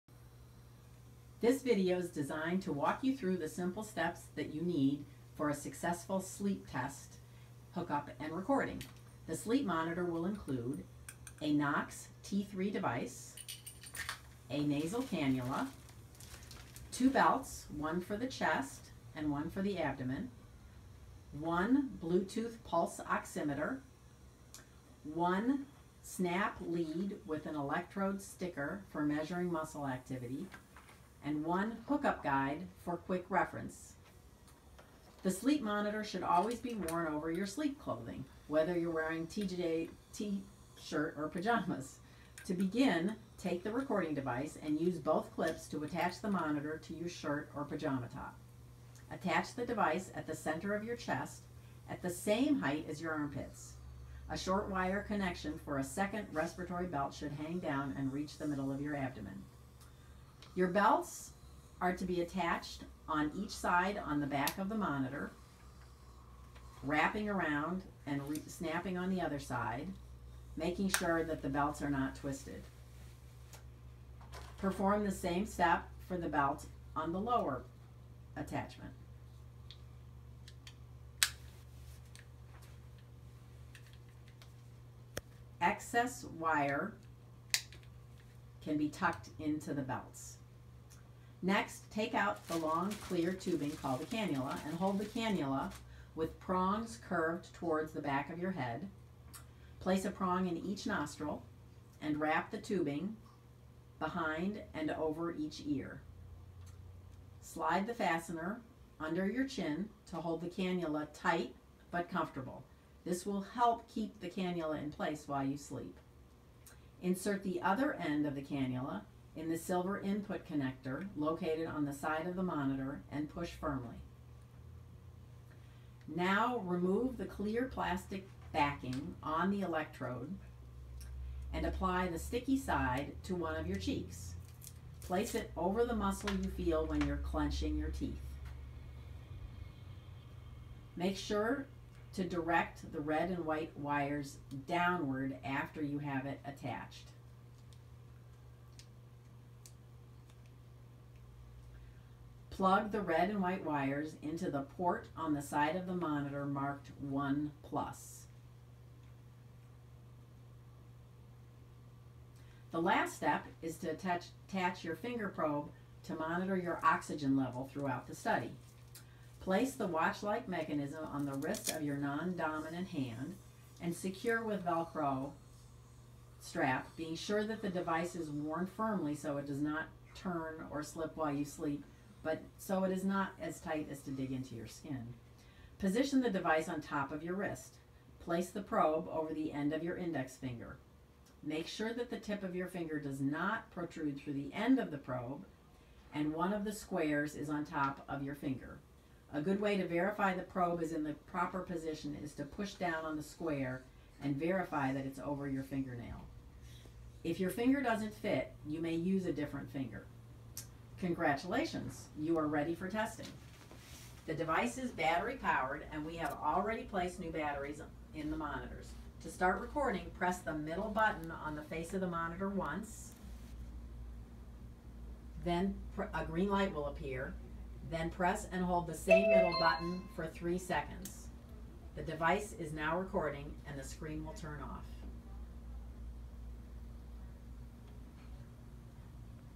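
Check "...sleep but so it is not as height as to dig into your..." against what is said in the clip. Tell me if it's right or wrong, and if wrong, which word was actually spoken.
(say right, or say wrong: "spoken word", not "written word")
wrong: "tight", not "height".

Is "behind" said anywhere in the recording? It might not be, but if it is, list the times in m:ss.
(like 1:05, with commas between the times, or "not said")
1:43.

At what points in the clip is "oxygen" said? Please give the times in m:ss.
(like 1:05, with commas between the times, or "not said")
2:46.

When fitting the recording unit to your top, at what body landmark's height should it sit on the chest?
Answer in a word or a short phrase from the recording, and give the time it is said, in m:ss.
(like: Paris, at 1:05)
armpits, at 0:53.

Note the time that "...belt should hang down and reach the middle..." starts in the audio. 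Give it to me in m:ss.
0:56.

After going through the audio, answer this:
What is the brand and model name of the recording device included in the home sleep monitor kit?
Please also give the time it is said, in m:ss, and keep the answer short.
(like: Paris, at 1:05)
NOX T3, at 0:11.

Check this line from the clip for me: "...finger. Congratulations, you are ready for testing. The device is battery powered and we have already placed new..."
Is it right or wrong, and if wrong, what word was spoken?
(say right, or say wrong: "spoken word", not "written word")
right.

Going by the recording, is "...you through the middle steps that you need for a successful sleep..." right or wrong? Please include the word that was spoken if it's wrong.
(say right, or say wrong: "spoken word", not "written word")
wrong: "simple", not "middle".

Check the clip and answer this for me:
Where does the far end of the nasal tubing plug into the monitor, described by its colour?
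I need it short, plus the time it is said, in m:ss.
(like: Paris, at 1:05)
silver input connector, at 1:59.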